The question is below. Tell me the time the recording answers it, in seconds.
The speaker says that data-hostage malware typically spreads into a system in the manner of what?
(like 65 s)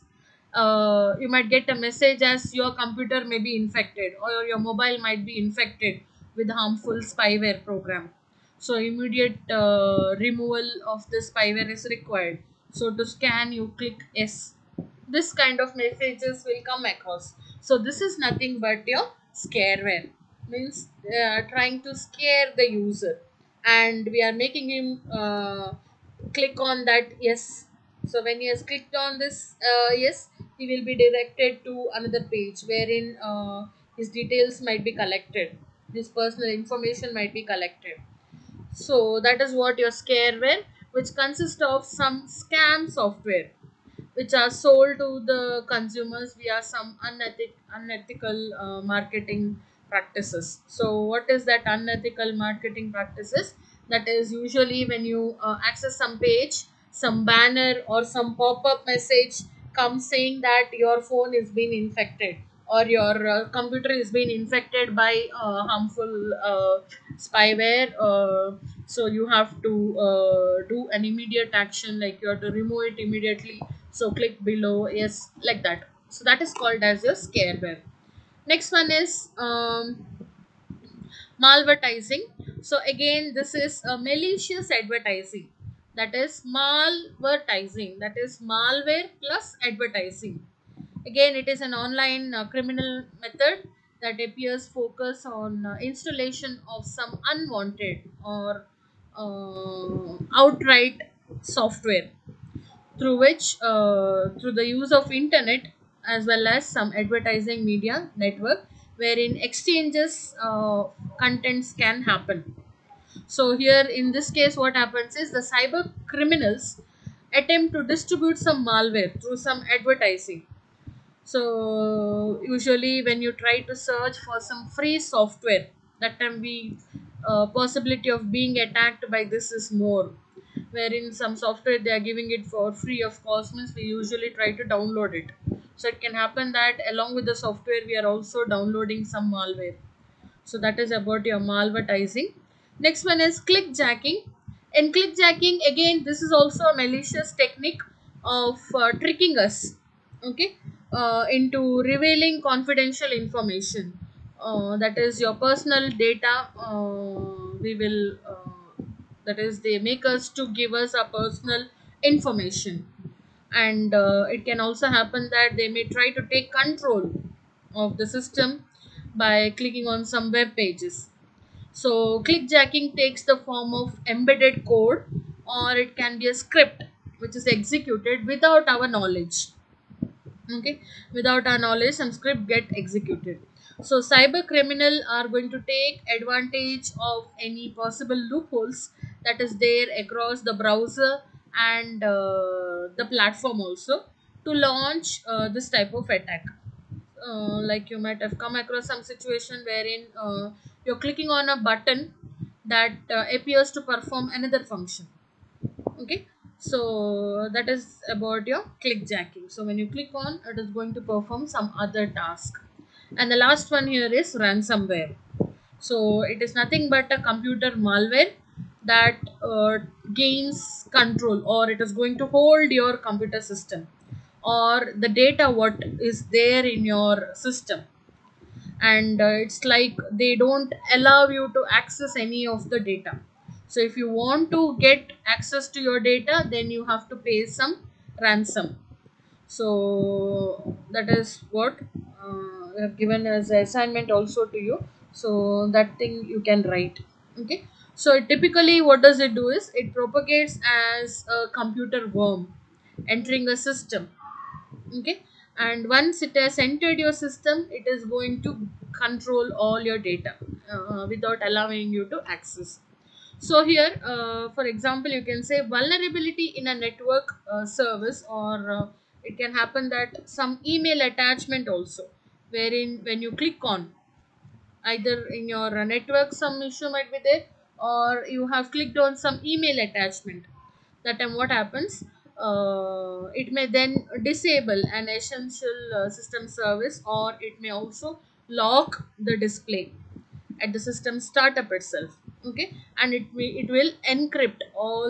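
251 s.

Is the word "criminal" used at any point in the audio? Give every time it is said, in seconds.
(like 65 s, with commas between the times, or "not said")
92 s, 116 s, 184 s.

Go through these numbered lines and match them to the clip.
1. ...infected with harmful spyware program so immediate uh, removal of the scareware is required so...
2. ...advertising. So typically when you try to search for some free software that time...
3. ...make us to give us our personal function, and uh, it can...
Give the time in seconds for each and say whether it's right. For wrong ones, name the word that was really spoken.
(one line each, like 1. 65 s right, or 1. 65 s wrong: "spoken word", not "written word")
1. 5 s wrong: "spyware", not "scareware"
2. 119 s wrong: "usually", not "typically"
3. 159 s wrong: "information", not "function".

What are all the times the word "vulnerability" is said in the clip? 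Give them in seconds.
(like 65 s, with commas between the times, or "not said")
265 s.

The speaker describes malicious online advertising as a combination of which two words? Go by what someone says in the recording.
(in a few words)
malware plus advertising.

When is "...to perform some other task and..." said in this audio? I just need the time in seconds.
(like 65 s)
210 s.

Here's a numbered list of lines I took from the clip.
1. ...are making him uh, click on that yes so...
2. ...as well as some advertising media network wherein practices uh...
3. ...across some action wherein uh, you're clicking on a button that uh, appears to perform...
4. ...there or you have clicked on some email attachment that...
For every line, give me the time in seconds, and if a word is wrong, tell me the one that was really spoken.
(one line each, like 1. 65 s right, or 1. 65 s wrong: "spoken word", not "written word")
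1. 24 s right
2. 106 s wrong: "exchanges", not "practices"
3. 198 s wrong: "situation", not "action"
4. 277 s right.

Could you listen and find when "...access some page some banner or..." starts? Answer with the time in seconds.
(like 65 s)
55 s.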